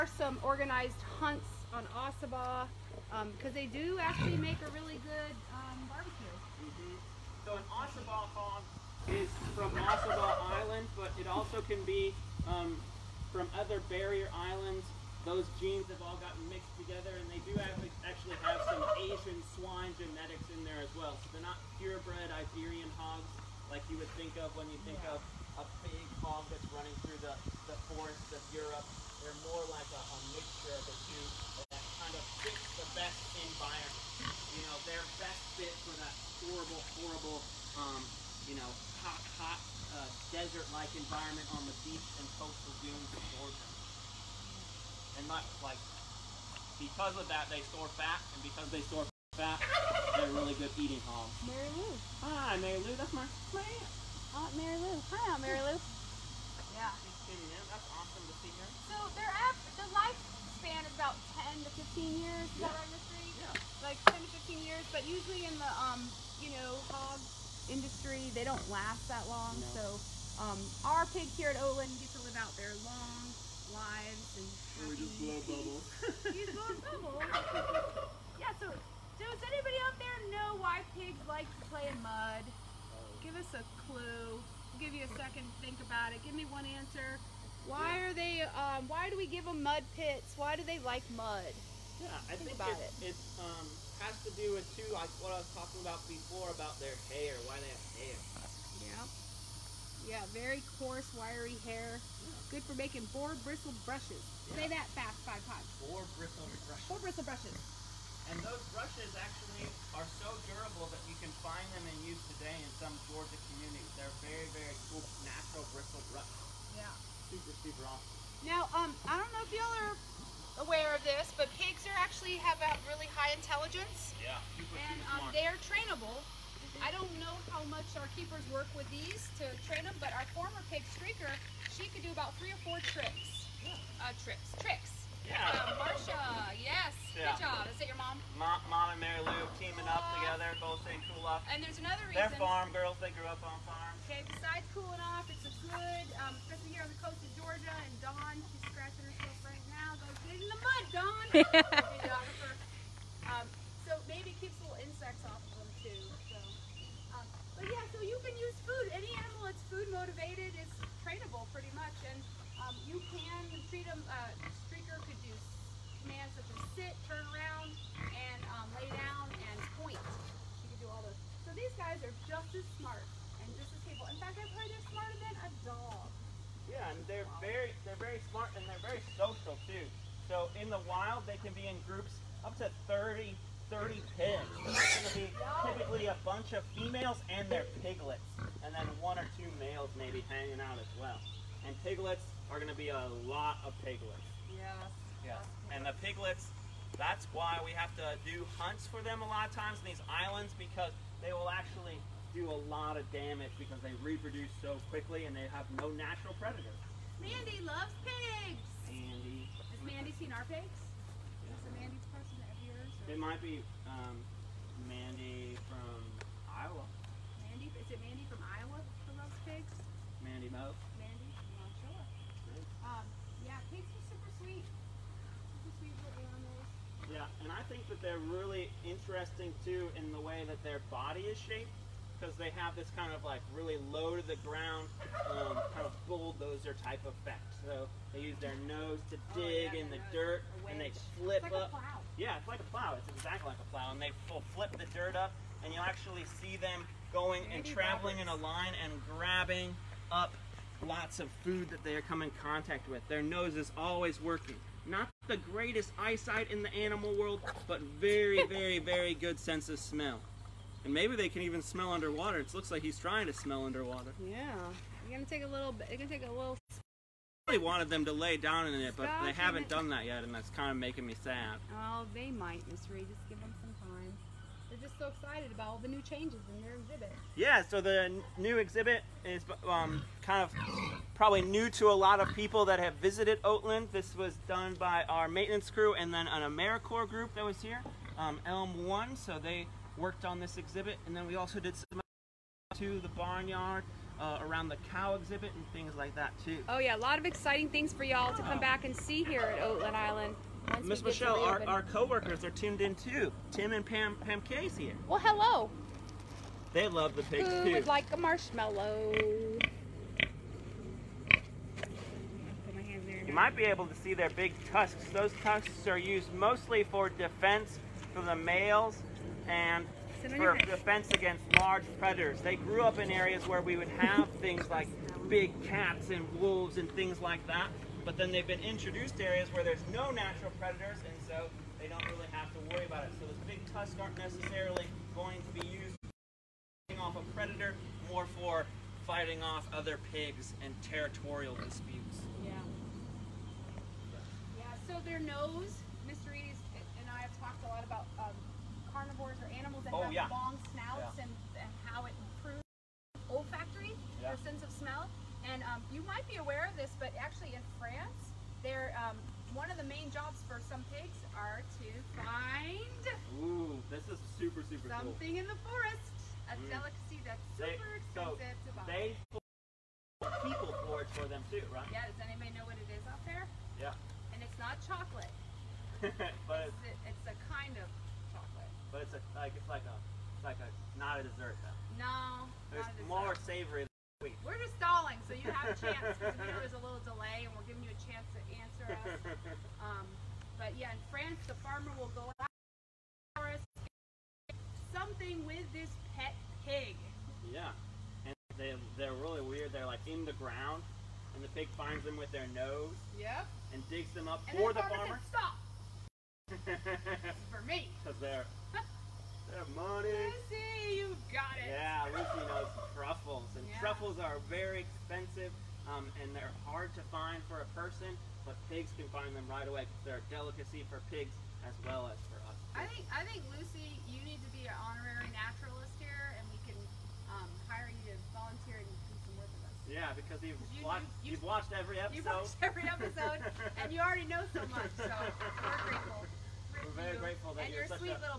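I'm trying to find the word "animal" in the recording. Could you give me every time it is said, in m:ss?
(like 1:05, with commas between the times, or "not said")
2:39, 3:46, 4:16.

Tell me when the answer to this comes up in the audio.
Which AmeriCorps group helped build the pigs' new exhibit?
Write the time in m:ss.
4:48.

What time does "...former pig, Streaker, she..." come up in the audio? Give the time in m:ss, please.
2:10.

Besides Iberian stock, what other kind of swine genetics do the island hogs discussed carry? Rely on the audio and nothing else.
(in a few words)
Asian.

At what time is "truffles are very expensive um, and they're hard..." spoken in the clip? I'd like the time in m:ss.
6:53.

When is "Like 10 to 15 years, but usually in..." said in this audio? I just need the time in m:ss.
1:03.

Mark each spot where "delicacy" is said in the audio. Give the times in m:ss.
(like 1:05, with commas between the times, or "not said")
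6:06, 7:00.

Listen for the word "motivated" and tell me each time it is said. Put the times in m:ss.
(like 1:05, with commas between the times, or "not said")
2:39.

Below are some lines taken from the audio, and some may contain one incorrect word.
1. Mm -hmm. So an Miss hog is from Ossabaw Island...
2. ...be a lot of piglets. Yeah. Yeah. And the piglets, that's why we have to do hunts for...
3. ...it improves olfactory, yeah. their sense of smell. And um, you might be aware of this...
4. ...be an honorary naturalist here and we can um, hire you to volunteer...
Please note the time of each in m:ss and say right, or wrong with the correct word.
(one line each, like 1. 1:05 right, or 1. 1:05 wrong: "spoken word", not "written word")
1. 0:06 wrong: "Ossabaw", not "Miss"
2. 3:12 right
3. 5:52 right
4. 7:04 right.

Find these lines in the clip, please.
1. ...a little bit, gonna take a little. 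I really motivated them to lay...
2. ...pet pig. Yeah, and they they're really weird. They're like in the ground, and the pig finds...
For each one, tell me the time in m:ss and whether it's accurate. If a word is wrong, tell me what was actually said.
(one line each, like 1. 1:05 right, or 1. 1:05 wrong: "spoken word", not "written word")
1. 4:25 wrong: "wanted", not "motivated"
2. 6:36 right.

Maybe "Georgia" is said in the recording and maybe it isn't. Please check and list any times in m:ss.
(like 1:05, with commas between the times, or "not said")
0:43, 1:53, 2:27.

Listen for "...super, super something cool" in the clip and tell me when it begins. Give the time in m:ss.
6:04.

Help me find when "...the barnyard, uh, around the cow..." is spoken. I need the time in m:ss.
4:52.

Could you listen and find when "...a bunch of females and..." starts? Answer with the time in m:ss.
3:06.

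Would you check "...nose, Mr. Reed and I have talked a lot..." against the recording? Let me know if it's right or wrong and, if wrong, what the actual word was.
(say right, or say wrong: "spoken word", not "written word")
right.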